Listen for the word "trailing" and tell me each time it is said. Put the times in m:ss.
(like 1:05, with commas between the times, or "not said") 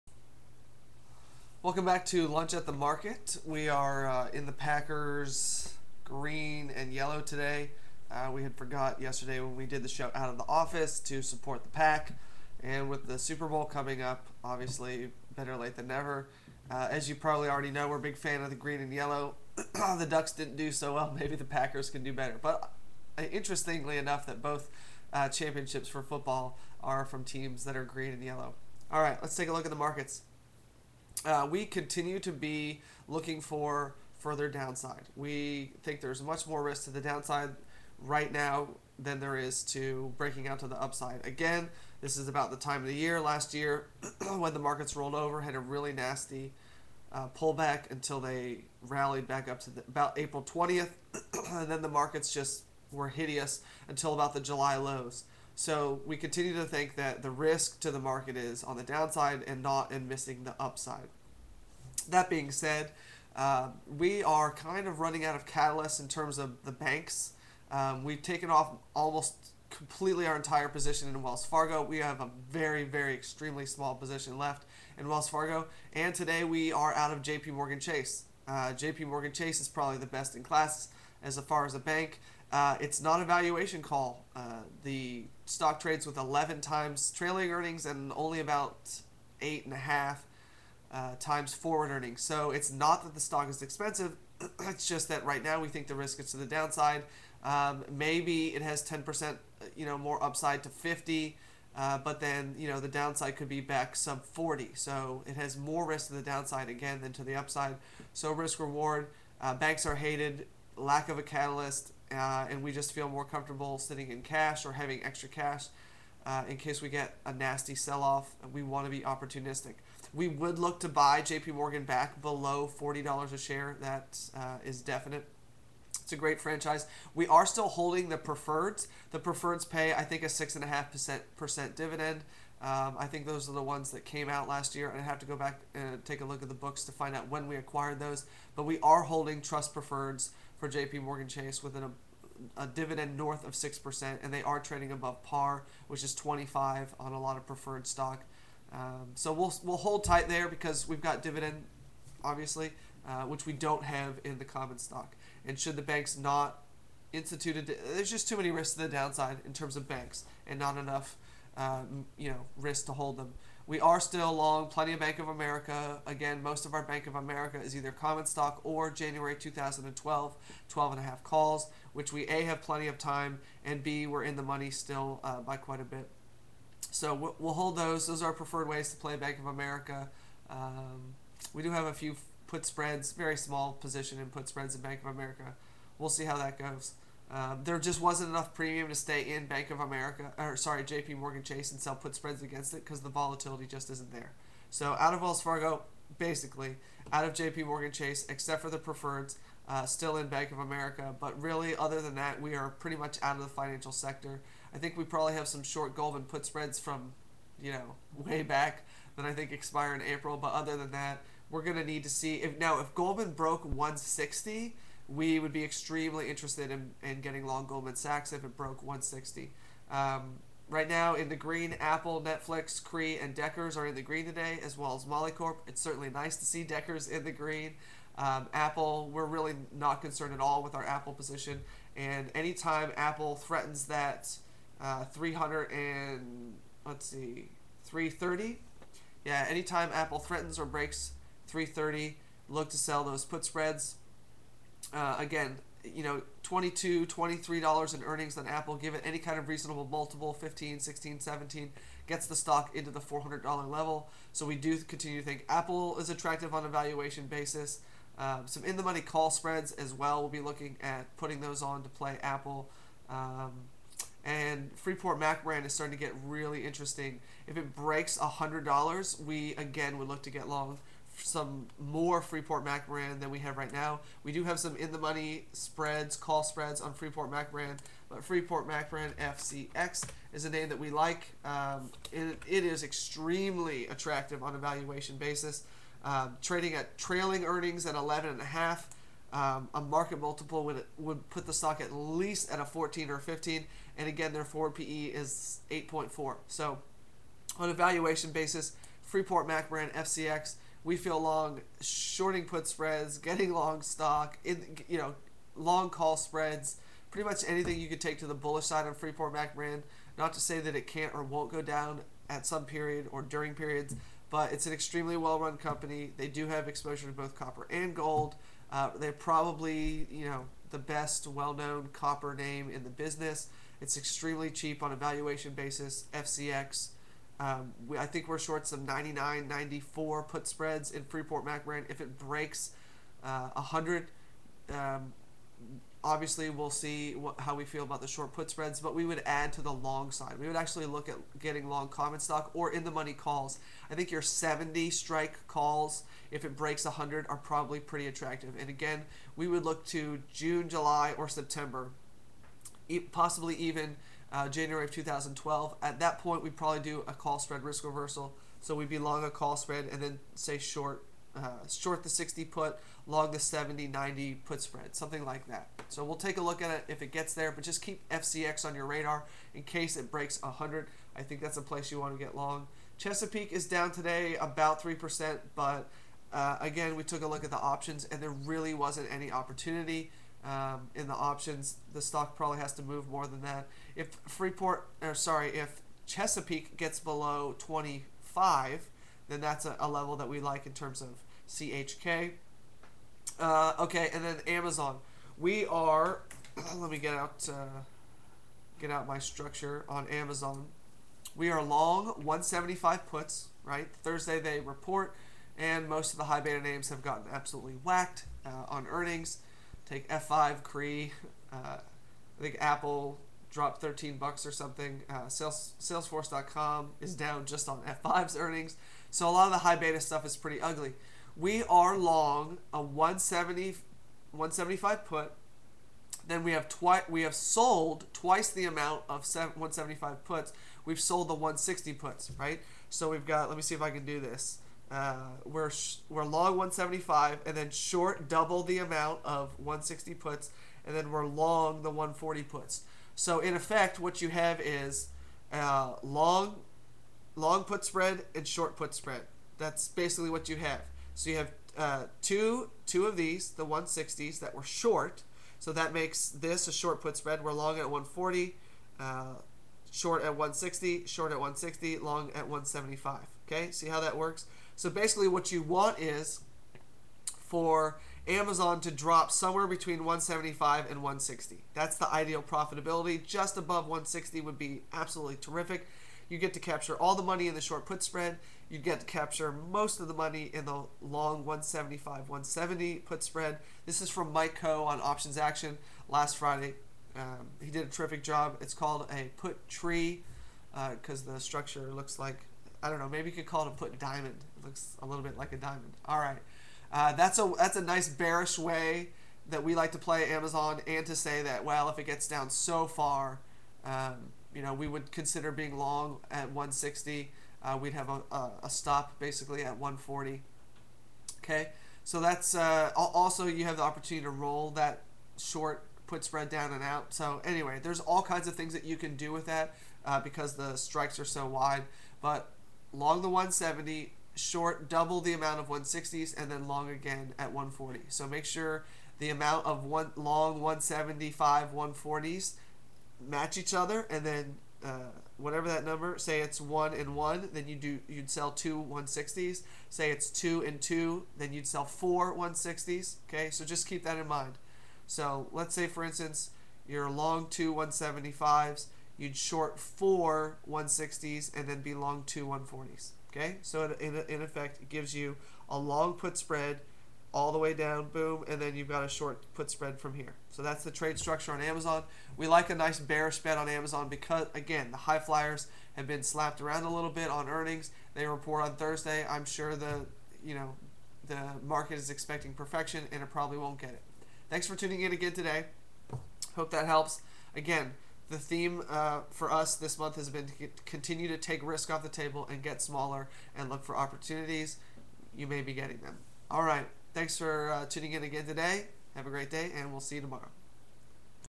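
1:27, 4:46.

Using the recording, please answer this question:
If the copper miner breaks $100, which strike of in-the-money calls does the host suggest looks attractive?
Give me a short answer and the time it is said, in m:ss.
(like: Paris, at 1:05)
70, at 5:44.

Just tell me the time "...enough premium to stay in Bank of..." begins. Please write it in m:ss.
3:08.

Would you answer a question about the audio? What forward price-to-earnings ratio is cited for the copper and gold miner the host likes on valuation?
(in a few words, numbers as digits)
8.4.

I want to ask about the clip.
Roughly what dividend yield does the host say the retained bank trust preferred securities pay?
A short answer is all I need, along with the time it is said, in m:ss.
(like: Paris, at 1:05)
6.5%, at 2:10.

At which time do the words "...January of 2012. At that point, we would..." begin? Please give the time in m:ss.
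5:54.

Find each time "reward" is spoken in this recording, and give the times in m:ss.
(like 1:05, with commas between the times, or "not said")
1:48.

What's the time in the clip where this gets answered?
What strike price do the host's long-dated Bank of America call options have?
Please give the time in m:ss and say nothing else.
2:50.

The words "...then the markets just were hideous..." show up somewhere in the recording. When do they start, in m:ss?
0:51.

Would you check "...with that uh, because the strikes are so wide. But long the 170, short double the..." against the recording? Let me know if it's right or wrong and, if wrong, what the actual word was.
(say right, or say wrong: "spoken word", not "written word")
right.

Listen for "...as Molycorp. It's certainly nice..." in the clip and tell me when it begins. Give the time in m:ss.
3:44.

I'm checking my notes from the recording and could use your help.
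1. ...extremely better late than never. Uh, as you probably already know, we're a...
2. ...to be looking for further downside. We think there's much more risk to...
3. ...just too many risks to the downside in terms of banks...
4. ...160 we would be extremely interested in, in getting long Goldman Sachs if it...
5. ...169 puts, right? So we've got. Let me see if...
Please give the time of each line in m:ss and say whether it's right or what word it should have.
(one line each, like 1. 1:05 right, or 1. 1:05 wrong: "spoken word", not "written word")
1. 0:14 wrong: "obviously", not "extremely"
2. 0:32 right
3. 2:38 right
4. 3:33 right
5. 7:11 wrong: "160", not "169".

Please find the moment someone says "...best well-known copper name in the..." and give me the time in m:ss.
5:20.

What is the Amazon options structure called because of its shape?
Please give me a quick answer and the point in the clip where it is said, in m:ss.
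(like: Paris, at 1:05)
put tree, at 8:09.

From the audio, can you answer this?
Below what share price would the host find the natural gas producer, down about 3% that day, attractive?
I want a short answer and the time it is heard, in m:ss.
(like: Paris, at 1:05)
25, at 6:26.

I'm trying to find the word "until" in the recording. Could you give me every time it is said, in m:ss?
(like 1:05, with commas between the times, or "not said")
0:47, 0:53.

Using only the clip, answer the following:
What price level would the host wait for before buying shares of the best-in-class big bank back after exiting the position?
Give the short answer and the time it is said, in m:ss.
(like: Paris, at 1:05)
below $40, at 2:02.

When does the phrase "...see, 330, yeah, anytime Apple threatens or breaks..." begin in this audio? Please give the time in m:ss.
3:57.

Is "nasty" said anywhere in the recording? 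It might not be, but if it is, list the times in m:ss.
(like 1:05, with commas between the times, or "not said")
0:45, 1:57.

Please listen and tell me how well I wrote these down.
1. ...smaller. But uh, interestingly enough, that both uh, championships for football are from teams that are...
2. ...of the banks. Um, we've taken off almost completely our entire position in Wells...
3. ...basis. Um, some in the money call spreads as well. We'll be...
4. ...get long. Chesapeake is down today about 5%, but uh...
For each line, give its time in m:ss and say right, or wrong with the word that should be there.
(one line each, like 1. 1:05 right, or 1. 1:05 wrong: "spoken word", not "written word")
1. 0:22 wrong: "better", not "smaller"
2. 1:06 right
3. 4:17 right
4. 6:12 wrong: "3", not "5".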